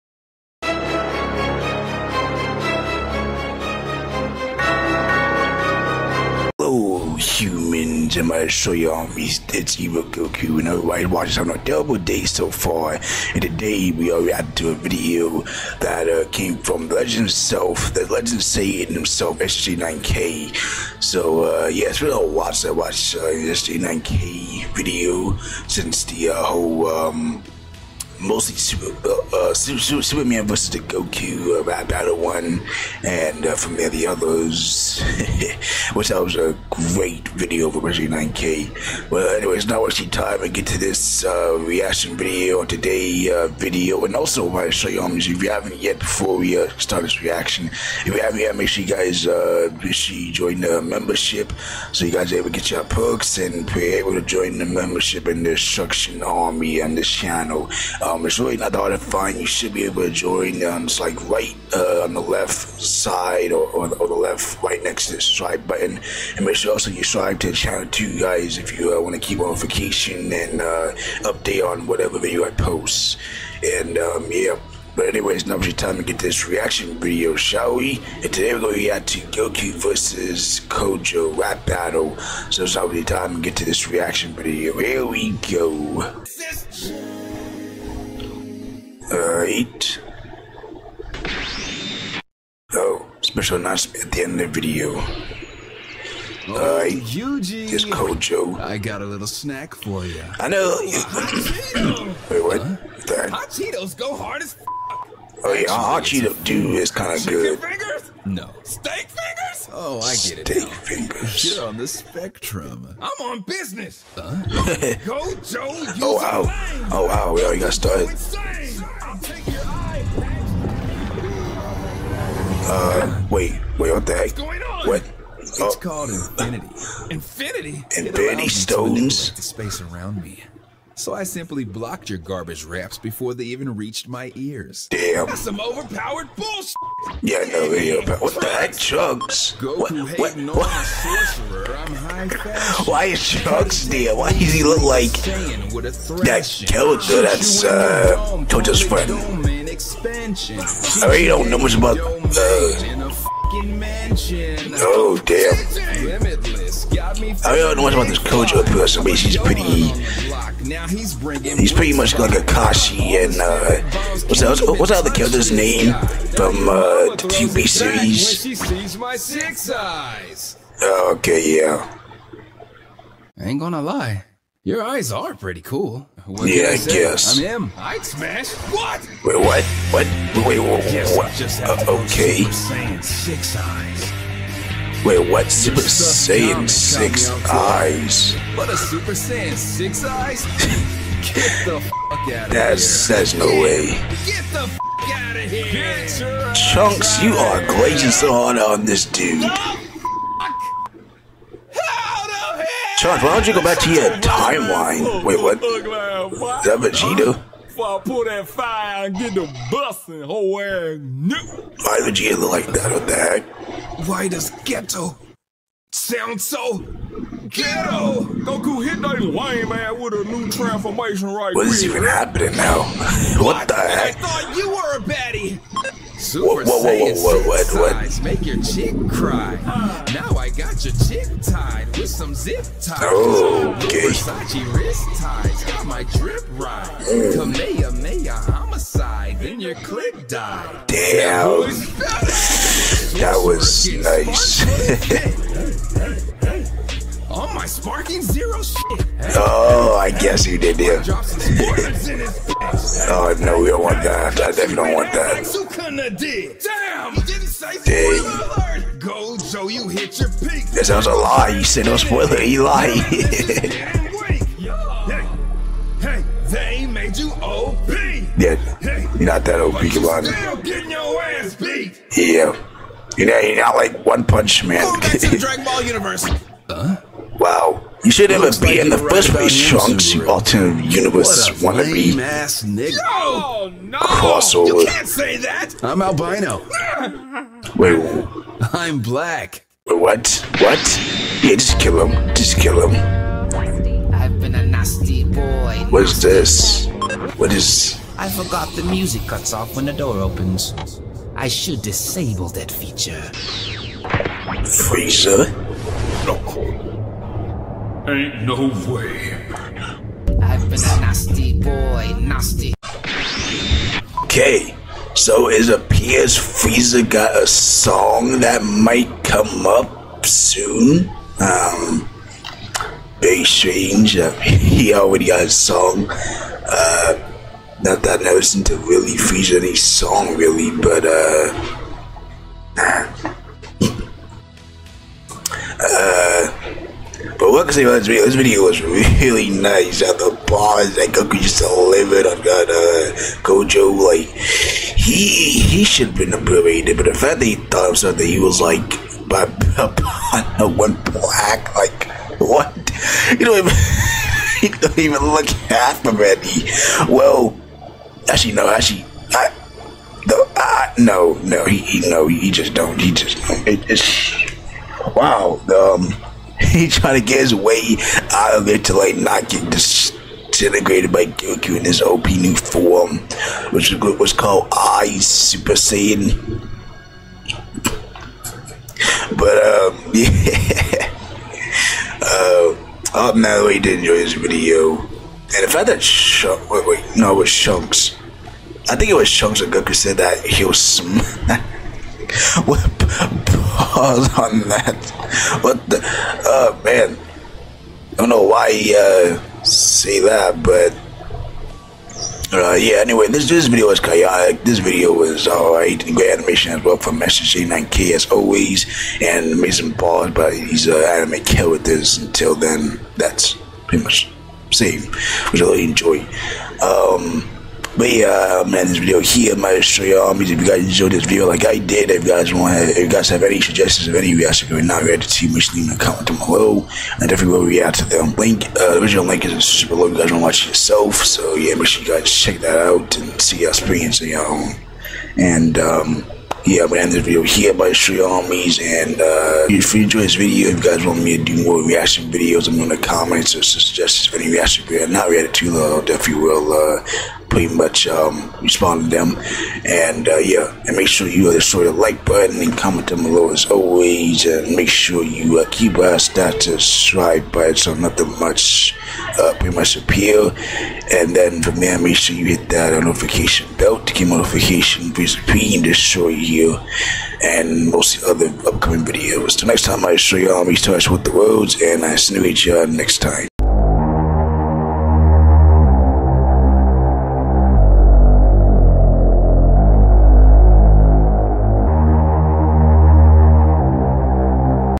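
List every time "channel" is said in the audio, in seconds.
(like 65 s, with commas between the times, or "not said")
57 s, 67 s.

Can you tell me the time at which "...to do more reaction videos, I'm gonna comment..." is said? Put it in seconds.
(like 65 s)
441 s.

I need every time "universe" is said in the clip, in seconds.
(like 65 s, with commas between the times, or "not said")
275 s, 280 s.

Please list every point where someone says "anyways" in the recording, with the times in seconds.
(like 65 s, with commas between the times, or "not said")
39 s, 75 s, 402 s.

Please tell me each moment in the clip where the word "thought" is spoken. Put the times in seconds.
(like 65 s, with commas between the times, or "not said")
224 s, 347 s.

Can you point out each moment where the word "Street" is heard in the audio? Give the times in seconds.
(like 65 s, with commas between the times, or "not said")
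437 s.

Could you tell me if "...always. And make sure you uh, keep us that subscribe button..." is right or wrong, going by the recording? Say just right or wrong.
right.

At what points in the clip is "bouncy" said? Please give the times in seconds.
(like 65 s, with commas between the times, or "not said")
not said.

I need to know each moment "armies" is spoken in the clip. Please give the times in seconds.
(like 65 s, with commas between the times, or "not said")
8 s, 438 s.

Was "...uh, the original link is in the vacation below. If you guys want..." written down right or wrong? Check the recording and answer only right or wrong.
wrong.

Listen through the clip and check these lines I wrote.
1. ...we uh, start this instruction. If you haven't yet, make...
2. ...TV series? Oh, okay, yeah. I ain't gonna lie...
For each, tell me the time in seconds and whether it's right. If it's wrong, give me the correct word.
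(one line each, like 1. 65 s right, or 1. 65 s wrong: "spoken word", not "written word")
1. 46 s wrong: "reaction", not "instruction"
2. 167 s right.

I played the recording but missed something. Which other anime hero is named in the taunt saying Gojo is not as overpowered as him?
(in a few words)
One Punch Man.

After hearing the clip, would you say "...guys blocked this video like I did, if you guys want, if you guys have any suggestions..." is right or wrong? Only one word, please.
wrong.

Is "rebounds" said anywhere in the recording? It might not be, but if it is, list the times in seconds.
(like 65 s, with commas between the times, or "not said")
not said.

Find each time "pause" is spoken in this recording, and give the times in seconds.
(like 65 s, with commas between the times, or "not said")
394 s, 409 s.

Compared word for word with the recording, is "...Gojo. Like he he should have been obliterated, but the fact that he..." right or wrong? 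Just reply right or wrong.
right.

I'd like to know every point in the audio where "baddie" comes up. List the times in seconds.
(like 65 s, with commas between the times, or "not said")
224 s.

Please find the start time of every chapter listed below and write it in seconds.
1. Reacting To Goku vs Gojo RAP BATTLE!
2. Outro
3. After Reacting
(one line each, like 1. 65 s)
1. 85 s
2. 469 s
3. 313 s.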